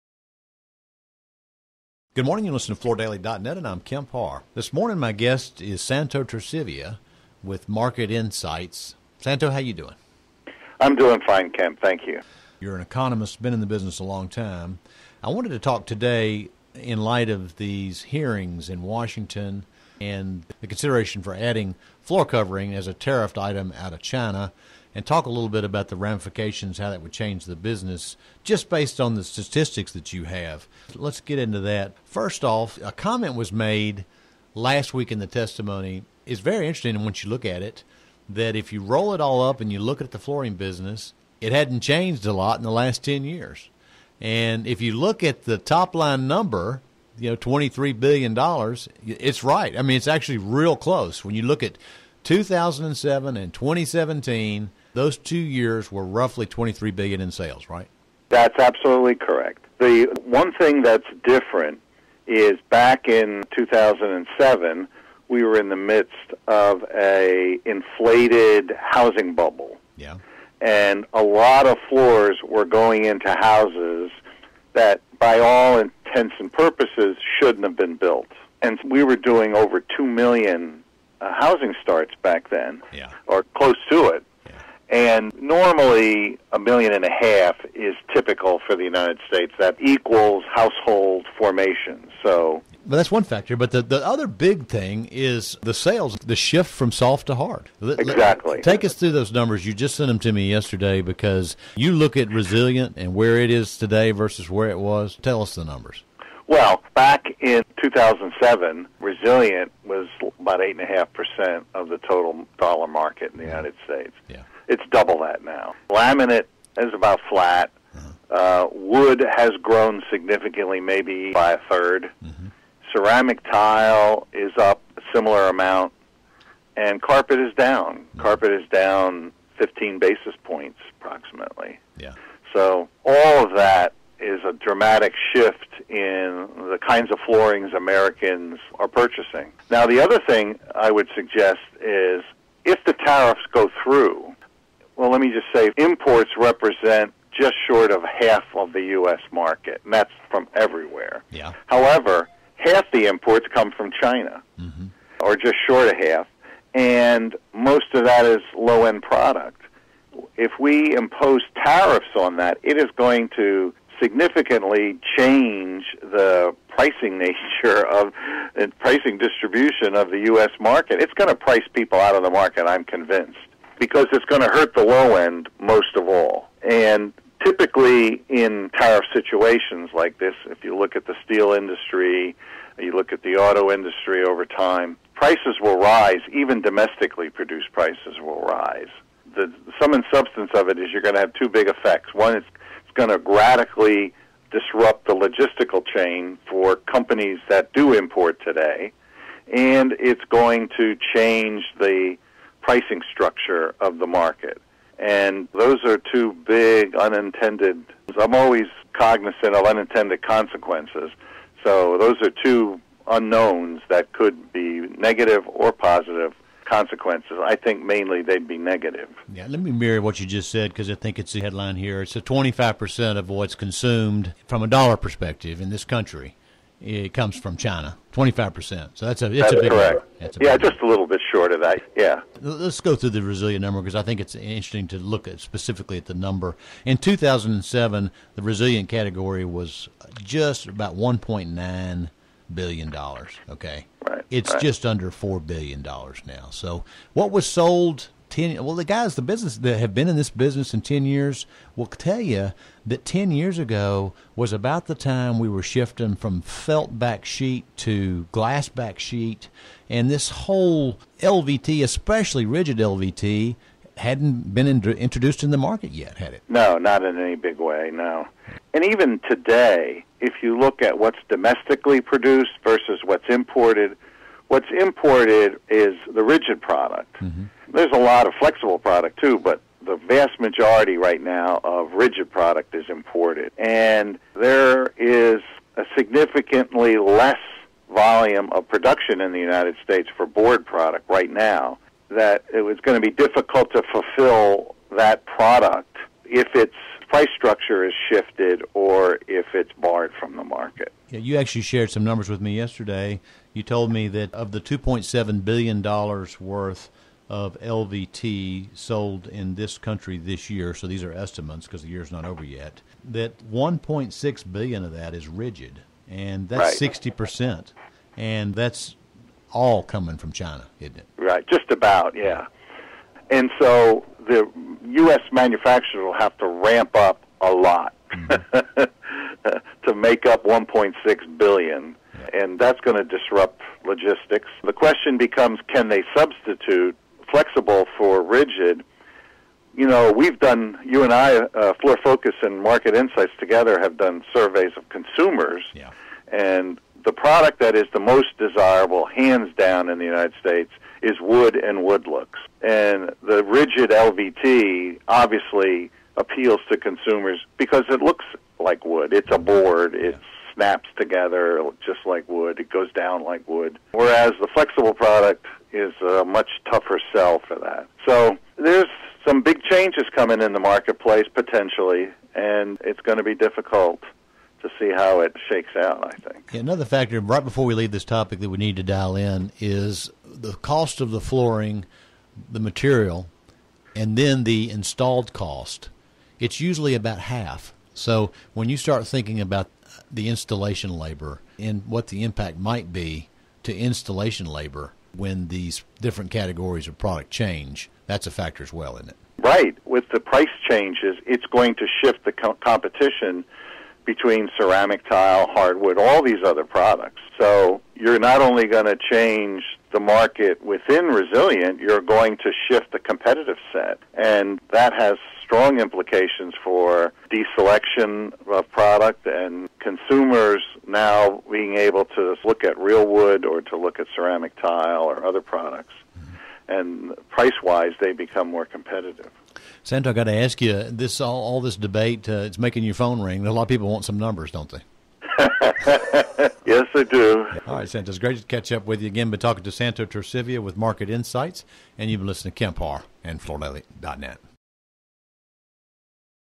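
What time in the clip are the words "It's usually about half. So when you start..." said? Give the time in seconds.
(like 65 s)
386 s.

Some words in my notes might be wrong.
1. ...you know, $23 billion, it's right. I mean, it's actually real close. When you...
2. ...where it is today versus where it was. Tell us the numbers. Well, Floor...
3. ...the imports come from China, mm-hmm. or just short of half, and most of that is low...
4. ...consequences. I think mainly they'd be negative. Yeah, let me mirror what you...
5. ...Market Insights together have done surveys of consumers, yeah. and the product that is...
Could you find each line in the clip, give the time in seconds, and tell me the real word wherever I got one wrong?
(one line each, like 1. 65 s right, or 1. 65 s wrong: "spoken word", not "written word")
1. 47 s right
2. 103 s wrong: "Back", not "Floor"
3. 152 s right
4. 216 s right
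5. 342 s right.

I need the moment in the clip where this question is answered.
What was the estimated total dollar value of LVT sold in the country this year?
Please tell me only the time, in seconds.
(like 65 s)
304 s.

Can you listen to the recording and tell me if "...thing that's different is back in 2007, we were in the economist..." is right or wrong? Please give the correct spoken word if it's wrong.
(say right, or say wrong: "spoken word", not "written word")
wrong: "midst", not "economist".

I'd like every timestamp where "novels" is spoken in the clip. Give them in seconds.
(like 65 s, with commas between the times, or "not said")
not said.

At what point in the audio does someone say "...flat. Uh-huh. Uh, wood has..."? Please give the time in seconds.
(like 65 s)
117 s.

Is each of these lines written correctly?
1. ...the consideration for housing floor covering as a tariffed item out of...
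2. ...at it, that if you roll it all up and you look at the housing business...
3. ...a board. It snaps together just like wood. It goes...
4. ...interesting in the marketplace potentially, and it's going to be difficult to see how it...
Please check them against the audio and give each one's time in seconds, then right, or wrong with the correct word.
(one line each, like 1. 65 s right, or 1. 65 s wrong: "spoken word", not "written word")
1. 20 s wrong: "adding", not "housing"
2. 37 s wrong: "flooring", not "housing"
3. 359 s right
4. 370 s wrong: "coming", not "interesting".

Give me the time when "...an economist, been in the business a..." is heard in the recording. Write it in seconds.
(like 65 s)
12 s.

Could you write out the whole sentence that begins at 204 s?
And those are two big unintended.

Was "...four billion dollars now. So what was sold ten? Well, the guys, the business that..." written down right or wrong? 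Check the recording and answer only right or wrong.
right.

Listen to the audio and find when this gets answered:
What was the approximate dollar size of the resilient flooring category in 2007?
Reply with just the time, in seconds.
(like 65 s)
240 s.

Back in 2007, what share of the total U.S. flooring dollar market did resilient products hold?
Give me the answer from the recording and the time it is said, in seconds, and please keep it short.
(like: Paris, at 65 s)
8.5%, at 110 s.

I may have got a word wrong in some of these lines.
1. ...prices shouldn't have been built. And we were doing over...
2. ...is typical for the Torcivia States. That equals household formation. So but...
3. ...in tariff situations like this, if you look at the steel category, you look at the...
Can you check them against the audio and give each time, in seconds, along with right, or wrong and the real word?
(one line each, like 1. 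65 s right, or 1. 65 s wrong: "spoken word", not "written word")
1. 76 s wrong: "purposes", not "prices"
2. 87 s wrong: "United", not "Torcivia"
3. 178 s wrong: "industry", not "category".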